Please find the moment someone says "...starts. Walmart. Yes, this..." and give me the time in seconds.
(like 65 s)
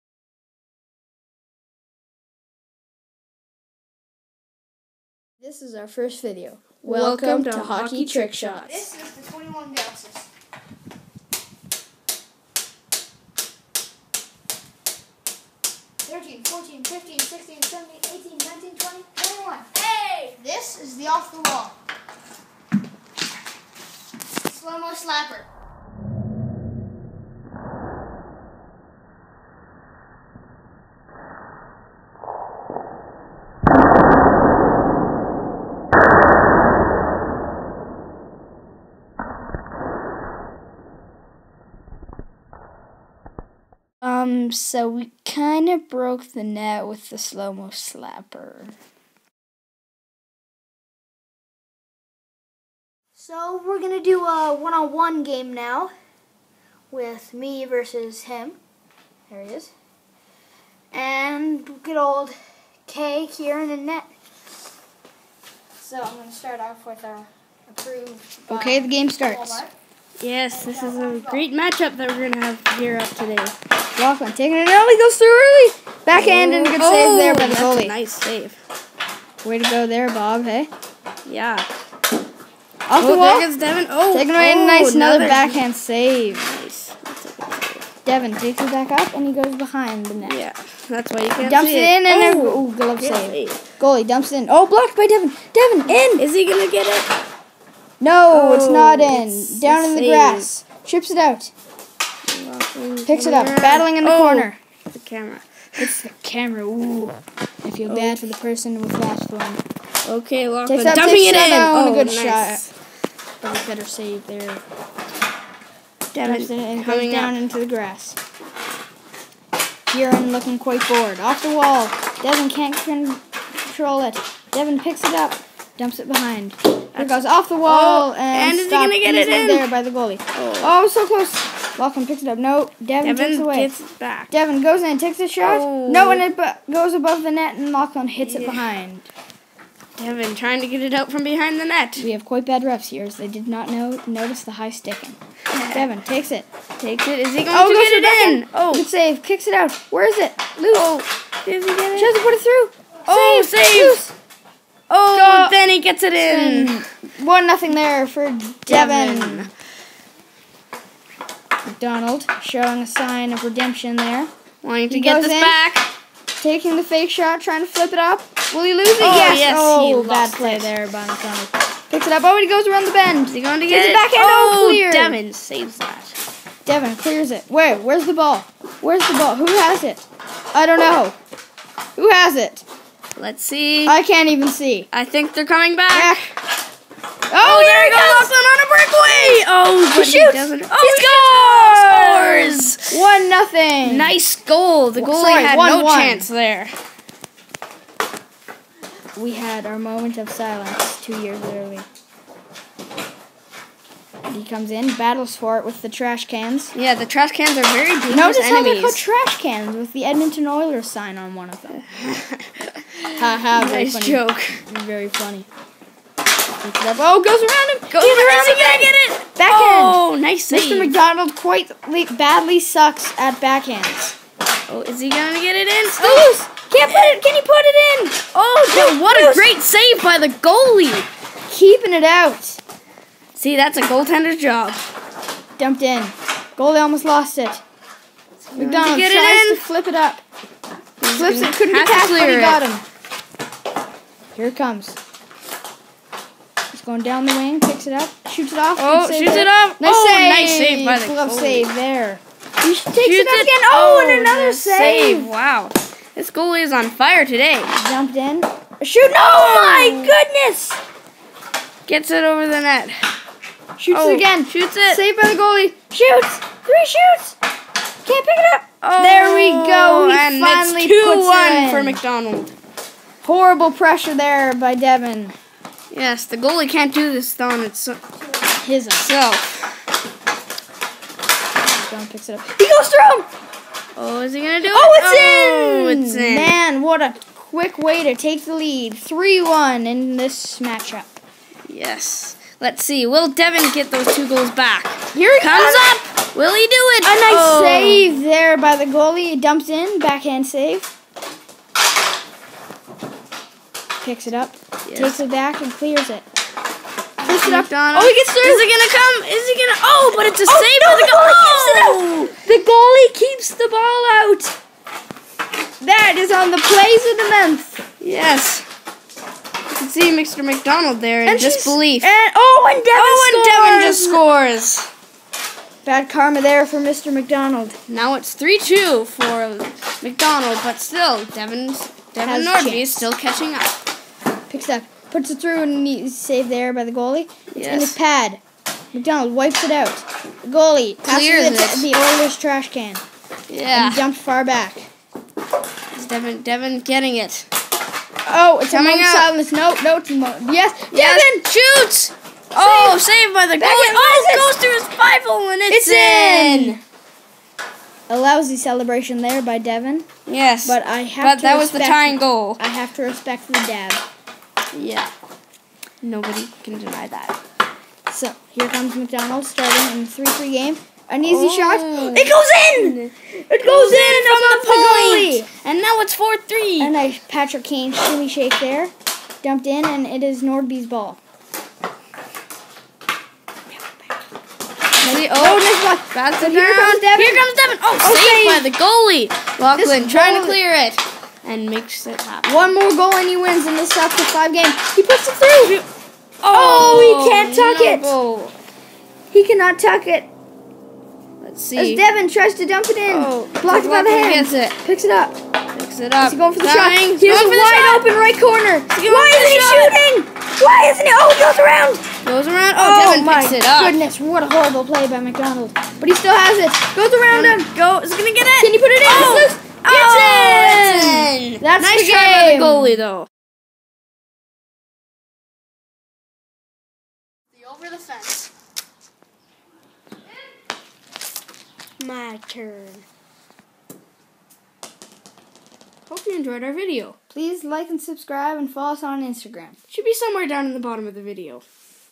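69 s.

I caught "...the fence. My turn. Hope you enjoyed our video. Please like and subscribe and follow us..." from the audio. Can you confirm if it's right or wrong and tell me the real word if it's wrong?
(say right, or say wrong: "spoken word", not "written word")
right.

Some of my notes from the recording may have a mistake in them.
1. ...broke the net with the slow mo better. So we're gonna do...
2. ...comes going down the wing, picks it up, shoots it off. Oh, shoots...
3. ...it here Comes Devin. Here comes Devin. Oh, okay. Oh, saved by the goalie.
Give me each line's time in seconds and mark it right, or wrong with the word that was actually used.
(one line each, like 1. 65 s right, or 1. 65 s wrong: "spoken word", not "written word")
1. 45 s wrong: "slapper", not "better"
2. 244 s right
3. 386 s right.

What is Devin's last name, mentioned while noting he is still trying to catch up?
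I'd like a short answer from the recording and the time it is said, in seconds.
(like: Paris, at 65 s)
Norby, at 332 s.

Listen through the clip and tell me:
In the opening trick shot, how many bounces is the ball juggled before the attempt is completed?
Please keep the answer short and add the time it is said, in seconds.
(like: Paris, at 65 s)
21, at 9 s.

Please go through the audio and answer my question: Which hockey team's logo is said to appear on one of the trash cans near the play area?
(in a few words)
Edmonton Oilers.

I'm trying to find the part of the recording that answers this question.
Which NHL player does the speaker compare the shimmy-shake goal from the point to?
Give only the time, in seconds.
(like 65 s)
377 s.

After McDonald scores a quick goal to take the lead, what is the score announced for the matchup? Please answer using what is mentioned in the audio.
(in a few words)
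3-1.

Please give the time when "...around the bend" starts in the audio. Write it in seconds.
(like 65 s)
172 s.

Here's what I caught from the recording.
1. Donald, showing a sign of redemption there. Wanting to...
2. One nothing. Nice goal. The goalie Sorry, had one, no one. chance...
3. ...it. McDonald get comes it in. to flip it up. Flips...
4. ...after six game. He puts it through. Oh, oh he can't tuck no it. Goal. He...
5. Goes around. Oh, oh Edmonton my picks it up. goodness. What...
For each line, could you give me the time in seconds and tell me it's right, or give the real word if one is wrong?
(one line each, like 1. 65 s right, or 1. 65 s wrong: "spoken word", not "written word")
1. 161 s right
2. 192 s right
3. 237 s wrong: "tries", not "comes"
4. 393 s wrong: "five", not "six"
5. 412 s wrong: "Devin", not "Edmonton".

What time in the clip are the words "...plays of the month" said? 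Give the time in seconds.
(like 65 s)
316 s.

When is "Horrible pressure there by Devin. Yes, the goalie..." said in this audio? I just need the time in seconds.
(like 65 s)
273 s.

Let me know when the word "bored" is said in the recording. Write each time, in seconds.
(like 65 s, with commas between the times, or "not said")
120 s.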